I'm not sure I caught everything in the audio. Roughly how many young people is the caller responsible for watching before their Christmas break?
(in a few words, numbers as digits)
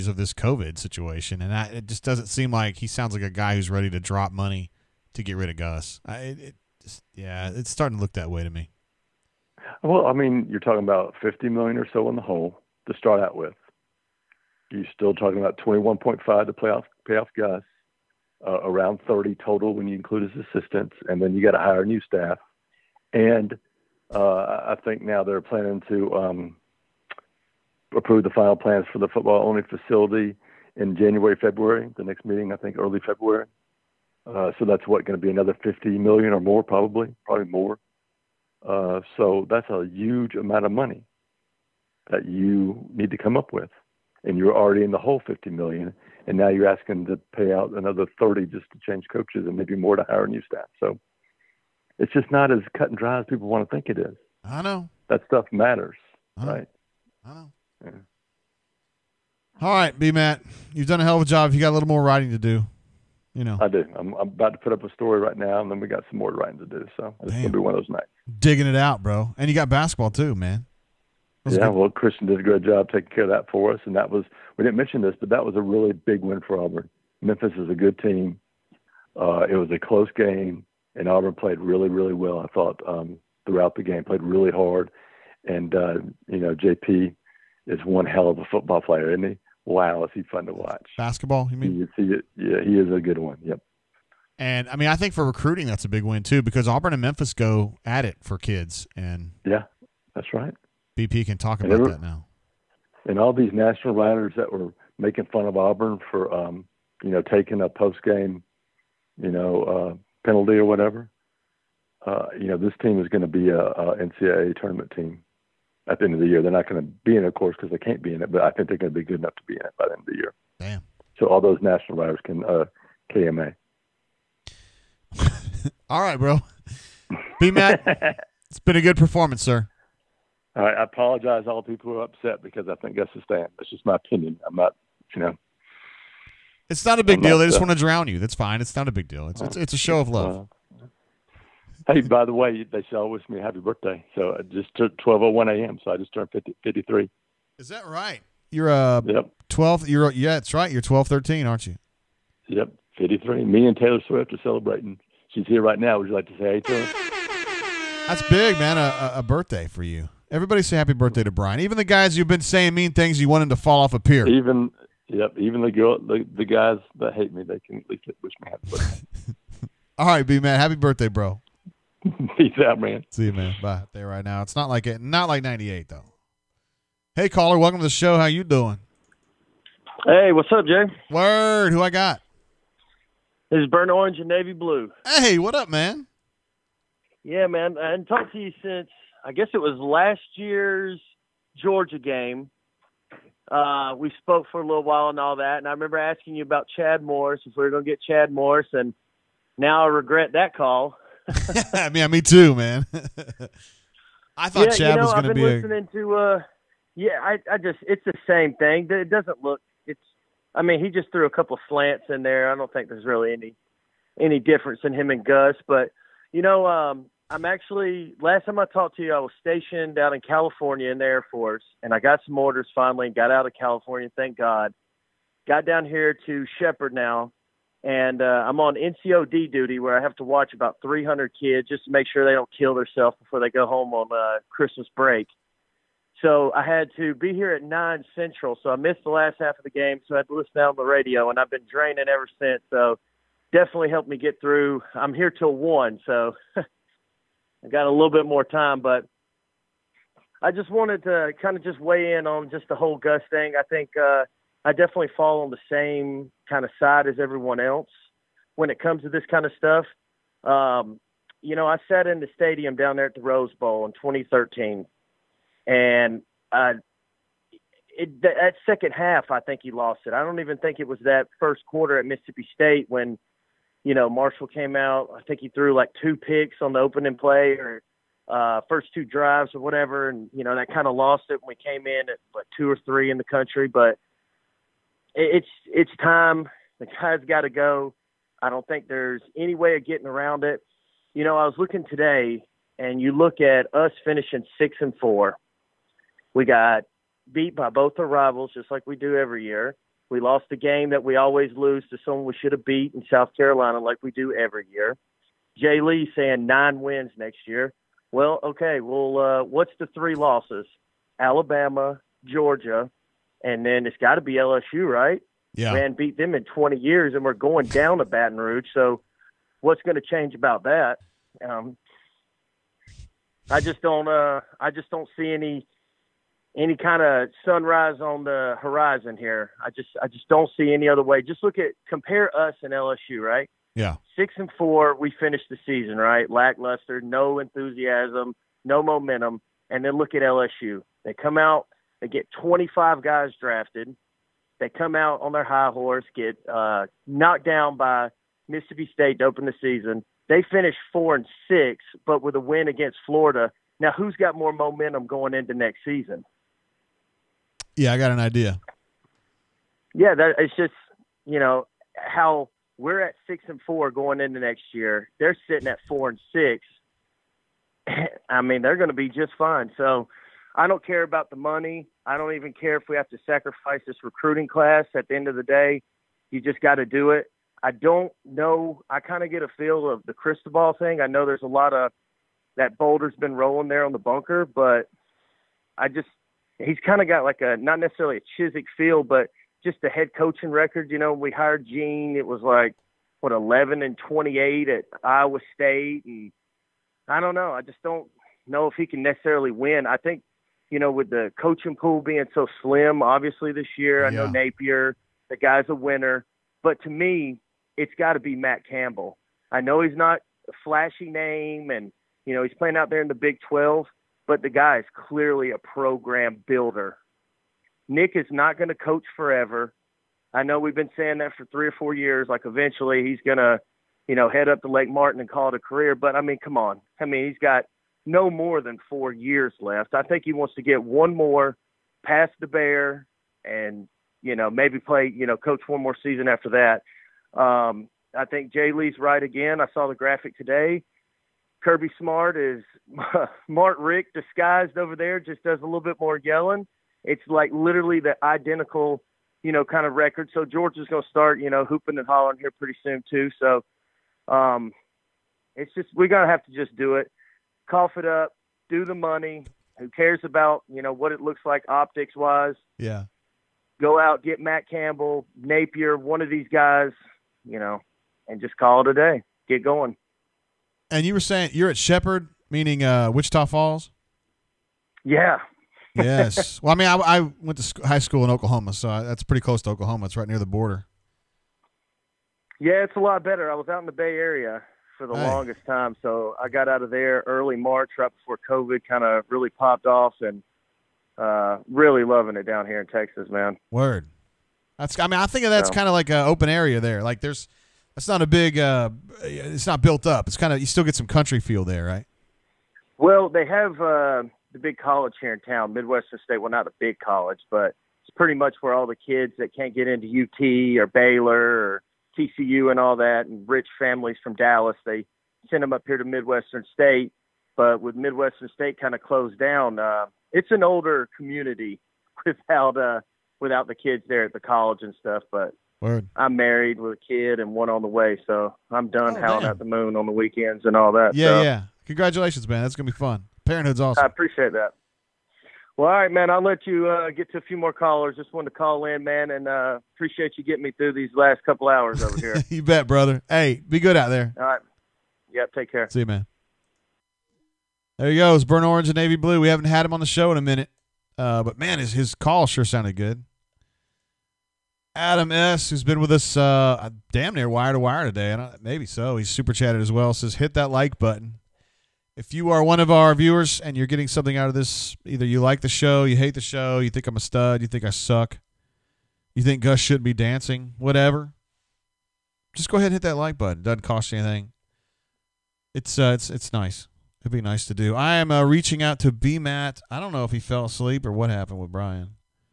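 300.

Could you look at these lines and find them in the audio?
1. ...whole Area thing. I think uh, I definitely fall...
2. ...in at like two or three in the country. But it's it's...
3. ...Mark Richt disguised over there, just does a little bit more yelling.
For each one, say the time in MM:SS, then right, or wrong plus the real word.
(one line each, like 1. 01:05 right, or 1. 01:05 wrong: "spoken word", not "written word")
1. 04:12 wrong: "Gus", not "Area"
2. 04:41 right
3. 07:23 right.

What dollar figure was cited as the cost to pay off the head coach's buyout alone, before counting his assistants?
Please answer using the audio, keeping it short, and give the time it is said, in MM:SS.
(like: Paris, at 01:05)
21.5 million, at 00:15.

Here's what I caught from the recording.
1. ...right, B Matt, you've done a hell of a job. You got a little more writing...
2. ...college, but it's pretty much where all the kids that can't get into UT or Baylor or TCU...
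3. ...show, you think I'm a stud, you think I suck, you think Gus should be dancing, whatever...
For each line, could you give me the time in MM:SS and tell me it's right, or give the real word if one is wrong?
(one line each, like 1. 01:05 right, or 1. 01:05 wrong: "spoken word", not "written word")
1. 00:59 right
2. 08:26 right
3. 09:26 right.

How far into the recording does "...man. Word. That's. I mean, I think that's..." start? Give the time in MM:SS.
08:13.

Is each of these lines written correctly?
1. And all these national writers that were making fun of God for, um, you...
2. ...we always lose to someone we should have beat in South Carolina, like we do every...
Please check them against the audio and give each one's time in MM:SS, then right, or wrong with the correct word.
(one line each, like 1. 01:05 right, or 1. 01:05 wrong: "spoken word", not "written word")
1. 01:43 wrong: "Auburn", not "God"
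2. 05:01 right.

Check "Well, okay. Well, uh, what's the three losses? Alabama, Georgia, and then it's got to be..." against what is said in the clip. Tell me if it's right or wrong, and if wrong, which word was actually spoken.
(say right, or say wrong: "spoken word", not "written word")
right.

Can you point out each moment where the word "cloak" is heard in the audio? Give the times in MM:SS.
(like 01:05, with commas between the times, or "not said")
not said.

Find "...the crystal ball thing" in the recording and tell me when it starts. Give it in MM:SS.
06:20.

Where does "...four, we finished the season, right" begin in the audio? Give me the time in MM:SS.
05:34.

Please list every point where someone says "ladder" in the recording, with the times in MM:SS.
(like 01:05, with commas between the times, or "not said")
not said.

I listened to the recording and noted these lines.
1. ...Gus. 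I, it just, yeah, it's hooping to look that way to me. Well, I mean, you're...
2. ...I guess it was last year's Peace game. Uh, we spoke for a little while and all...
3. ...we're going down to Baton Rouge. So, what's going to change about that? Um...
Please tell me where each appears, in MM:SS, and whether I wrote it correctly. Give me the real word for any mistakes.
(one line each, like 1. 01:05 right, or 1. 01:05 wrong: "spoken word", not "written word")
1. 00:05 wrong: "starting", not "hooping"
2. 03:09 wrong: "Georgia", not "Peace"
3. 05:17 right.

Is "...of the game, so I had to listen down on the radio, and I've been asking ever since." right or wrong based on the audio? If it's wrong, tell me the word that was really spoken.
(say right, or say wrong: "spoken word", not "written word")
wrong: "draining", not "asking".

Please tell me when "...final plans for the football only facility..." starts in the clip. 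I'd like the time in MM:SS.
00:28.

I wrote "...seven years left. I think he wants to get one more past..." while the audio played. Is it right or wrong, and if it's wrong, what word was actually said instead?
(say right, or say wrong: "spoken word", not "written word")
wrong: "four", not "seven".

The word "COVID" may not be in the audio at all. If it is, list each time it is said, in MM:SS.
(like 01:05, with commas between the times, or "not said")
00:00, 08:08.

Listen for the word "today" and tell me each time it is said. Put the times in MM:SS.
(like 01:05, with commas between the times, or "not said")
04:51, 07:20, 09:18.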